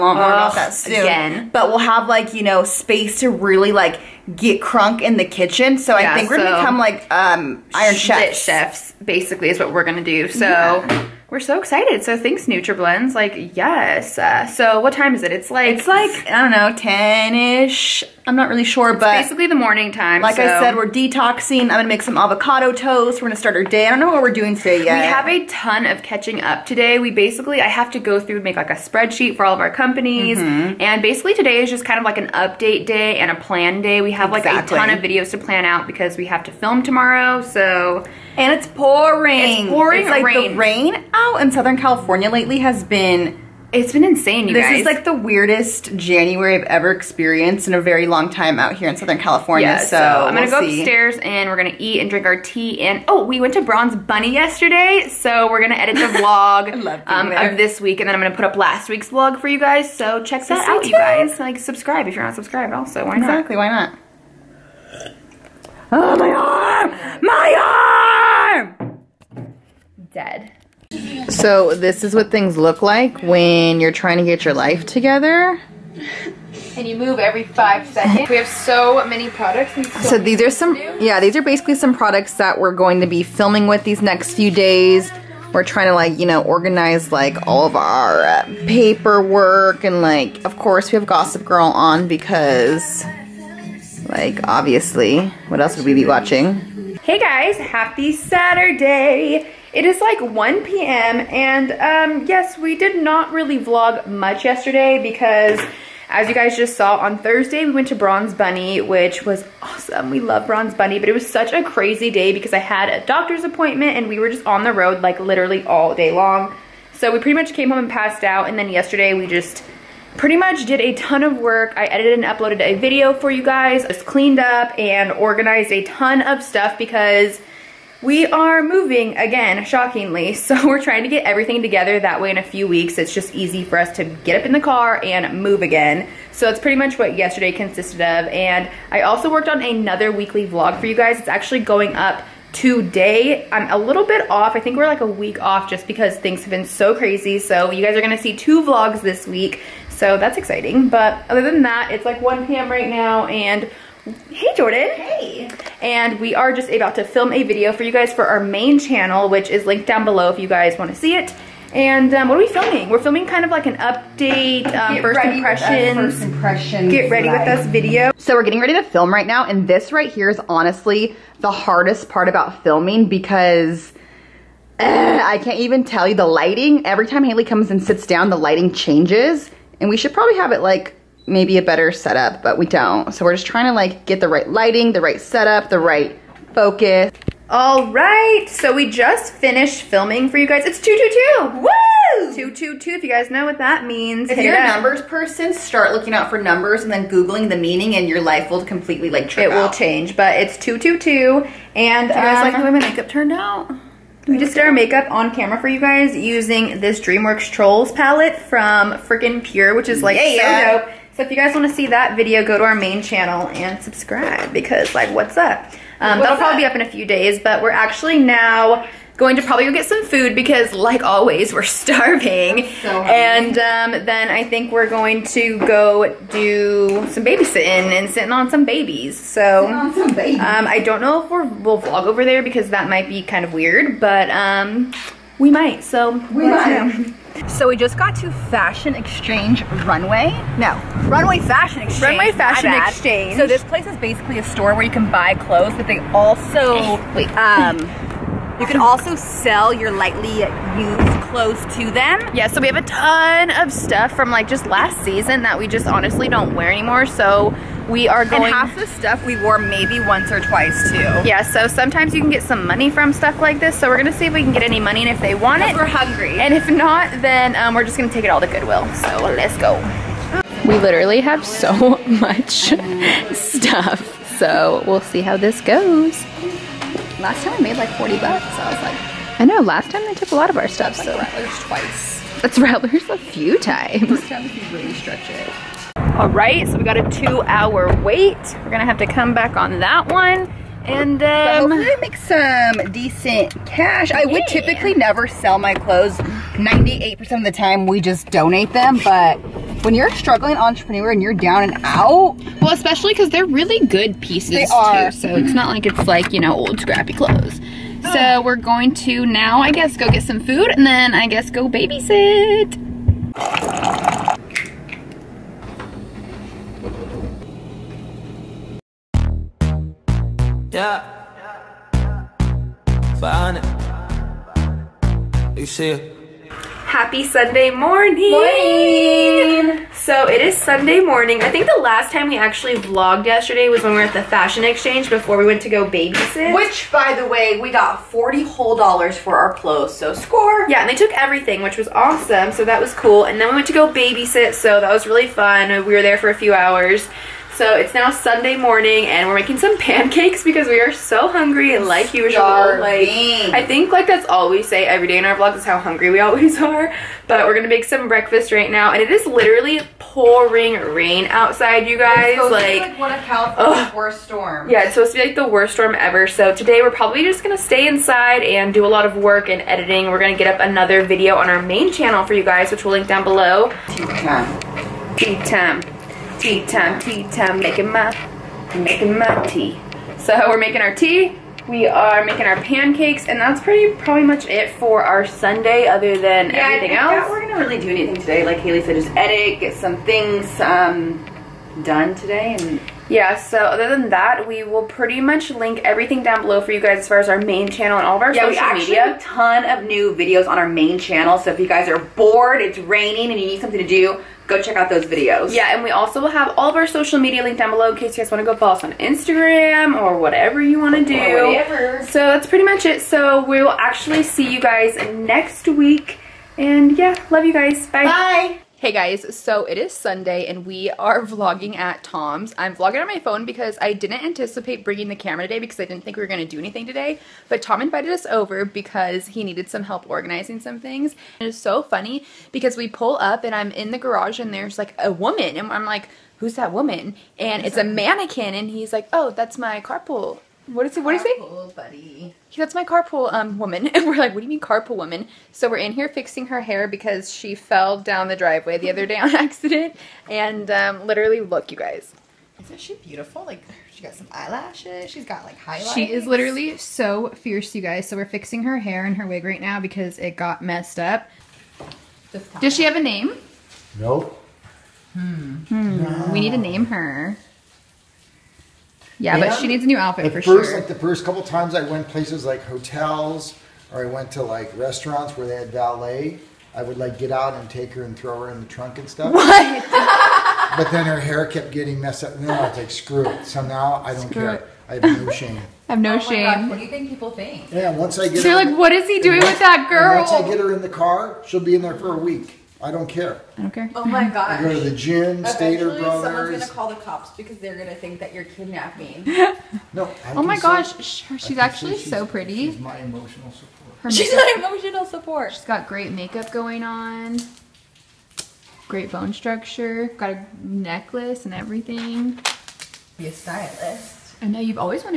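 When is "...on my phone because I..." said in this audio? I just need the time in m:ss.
7:03.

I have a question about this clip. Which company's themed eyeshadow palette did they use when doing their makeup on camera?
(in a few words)
Freaking Pure.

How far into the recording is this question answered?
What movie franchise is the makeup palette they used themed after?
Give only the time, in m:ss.
3:26.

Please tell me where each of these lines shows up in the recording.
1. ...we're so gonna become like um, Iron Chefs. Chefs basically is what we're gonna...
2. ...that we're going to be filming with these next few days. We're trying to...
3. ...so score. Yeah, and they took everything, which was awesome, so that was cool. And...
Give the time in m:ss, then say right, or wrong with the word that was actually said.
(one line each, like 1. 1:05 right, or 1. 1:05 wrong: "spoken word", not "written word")
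1. 0:06 right
2. 1:22 right
3. 5:39 right.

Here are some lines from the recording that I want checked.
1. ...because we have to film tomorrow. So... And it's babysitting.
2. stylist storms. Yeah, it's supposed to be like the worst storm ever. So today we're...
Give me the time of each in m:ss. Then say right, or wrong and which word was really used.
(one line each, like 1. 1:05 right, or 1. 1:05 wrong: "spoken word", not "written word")
1. 0:35 wrong: "pouring", not "babysitting"
2. 6:03 wrong: "worst", not "stylist".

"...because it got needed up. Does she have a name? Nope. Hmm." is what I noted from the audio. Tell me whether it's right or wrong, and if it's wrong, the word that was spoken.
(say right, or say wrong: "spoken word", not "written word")
wrong: "messed", not "needed".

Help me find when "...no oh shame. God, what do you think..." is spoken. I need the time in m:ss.
8:05.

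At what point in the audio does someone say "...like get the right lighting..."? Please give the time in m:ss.
3:03.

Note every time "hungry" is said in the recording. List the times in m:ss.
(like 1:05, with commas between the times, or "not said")
4:25, 5:51, 5:55.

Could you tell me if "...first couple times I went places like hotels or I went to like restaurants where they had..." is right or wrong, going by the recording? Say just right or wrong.
right.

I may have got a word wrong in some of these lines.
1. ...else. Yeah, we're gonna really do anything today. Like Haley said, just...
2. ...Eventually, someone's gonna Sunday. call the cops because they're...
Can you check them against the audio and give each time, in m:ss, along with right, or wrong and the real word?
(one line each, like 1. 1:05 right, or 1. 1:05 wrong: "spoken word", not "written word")
1. 6:26 right
2. 8:15 wrong: "Brothers", not "Sunday".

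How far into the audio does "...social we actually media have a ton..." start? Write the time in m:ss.
6:38.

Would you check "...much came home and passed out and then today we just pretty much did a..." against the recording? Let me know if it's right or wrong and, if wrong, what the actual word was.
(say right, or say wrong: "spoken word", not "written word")
wrong: "yesterday", not "today".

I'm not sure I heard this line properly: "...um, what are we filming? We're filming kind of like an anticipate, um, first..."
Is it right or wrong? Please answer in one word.
wrong.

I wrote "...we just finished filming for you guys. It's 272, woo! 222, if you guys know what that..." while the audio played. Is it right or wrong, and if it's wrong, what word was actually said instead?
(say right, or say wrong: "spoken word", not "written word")
wrong: "222", not "272".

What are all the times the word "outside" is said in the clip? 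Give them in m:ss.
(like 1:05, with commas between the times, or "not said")
6:01.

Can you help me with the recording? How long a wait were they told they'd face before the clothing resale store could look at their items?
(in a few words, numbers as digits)
two hour.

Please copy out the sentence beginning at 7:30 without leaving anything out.
And um, literally, look, you guys.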